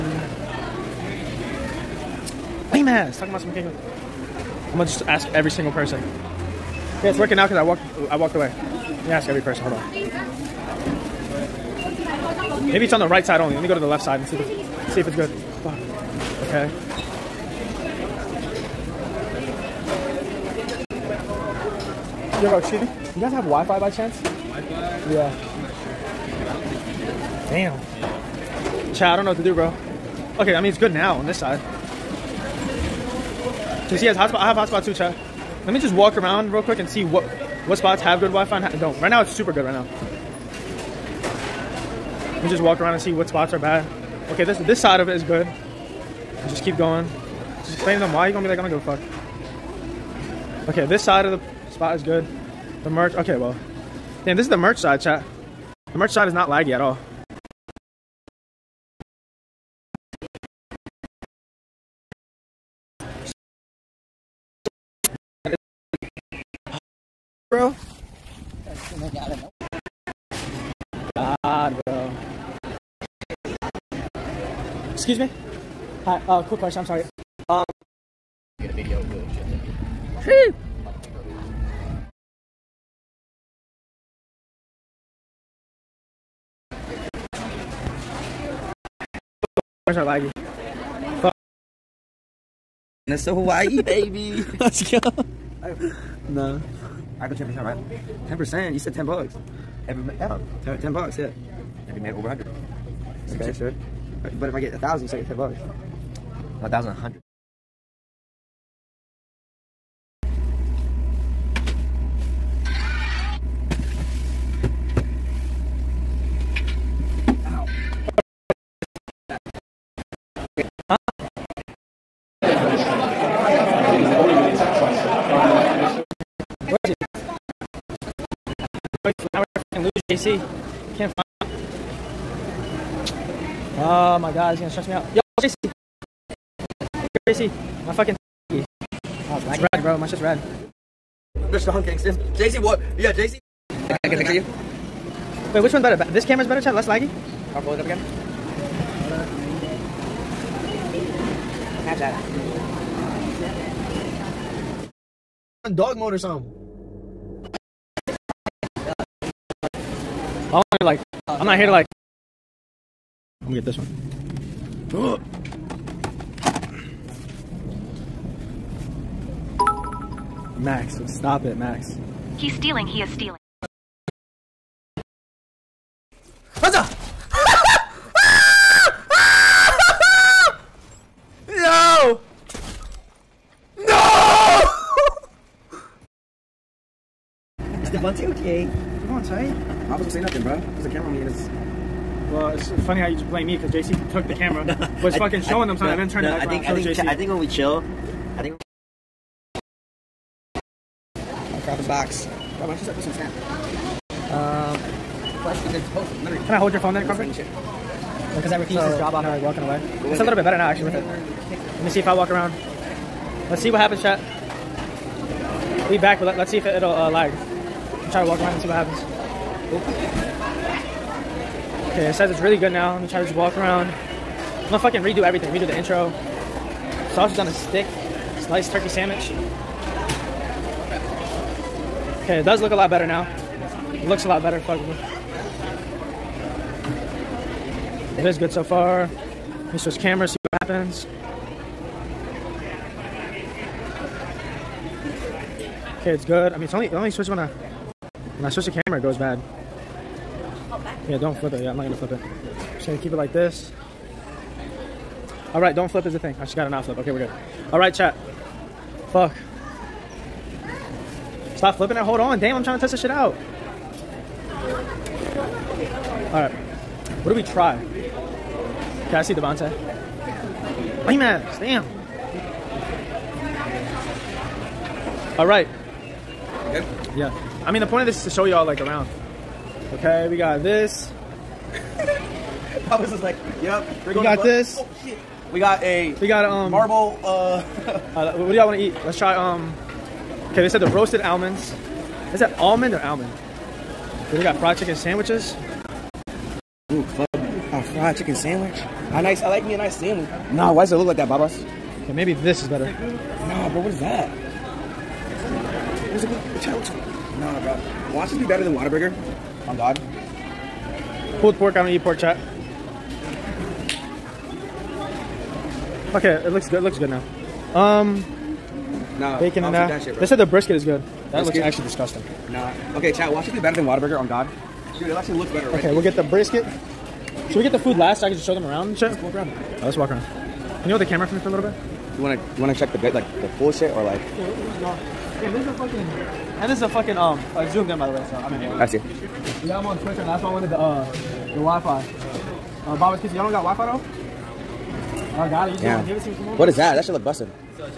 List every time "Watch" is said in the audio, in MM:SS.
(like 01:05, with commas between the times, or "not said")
05:08, 05:23.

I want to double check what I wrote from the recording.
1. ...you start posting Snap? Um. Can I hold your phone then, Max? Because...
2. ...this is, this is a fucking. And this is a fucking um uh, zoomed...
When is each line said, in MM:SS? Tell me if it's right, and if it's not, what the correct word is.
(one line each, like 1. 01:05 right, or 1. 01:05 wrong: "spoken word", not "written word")
1. 03:22 wrong: "Crawford", not "Max"
2. 05:34 right.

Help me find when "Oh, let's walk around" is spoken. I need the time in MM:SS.
05:29.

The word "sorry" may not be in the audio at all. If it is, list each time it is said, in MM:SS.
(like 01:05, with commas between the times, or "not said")
01:16.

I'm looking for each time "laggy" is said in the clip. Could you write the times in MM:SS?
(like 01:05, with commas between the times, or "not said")
00:56, 01:30, 02:26.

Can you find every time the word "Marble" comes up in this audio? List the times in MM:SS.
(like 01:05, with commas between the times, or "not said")
04:46.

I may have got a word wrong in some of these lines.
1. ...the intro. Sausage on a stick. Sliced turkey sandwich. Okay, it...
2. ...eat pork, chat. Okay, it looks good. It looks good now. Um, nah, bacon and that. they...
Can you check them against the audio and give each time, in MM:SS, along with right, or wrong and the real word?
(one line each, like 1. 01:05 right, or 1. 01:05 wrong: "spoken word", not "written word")
1. 03:45 right
2. 05:11 right.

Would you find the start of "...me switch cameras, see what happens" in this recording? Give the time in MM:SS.
03:59.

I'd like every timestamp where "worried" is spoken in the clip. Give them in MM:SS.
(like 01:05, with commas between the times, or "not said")
not said.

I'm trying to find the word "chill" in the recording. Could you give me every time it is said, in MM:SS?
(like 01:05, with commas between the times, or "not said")
03:17.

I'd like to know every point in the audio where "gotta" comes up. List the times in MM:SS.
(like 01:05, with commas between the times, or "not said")
04:16.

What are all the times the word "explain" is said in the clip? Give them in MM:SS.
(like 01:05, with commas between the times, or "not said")
00:47.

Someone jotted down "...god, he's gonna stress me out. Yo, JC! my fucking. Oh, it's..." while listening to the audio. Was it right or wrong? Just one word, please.
right.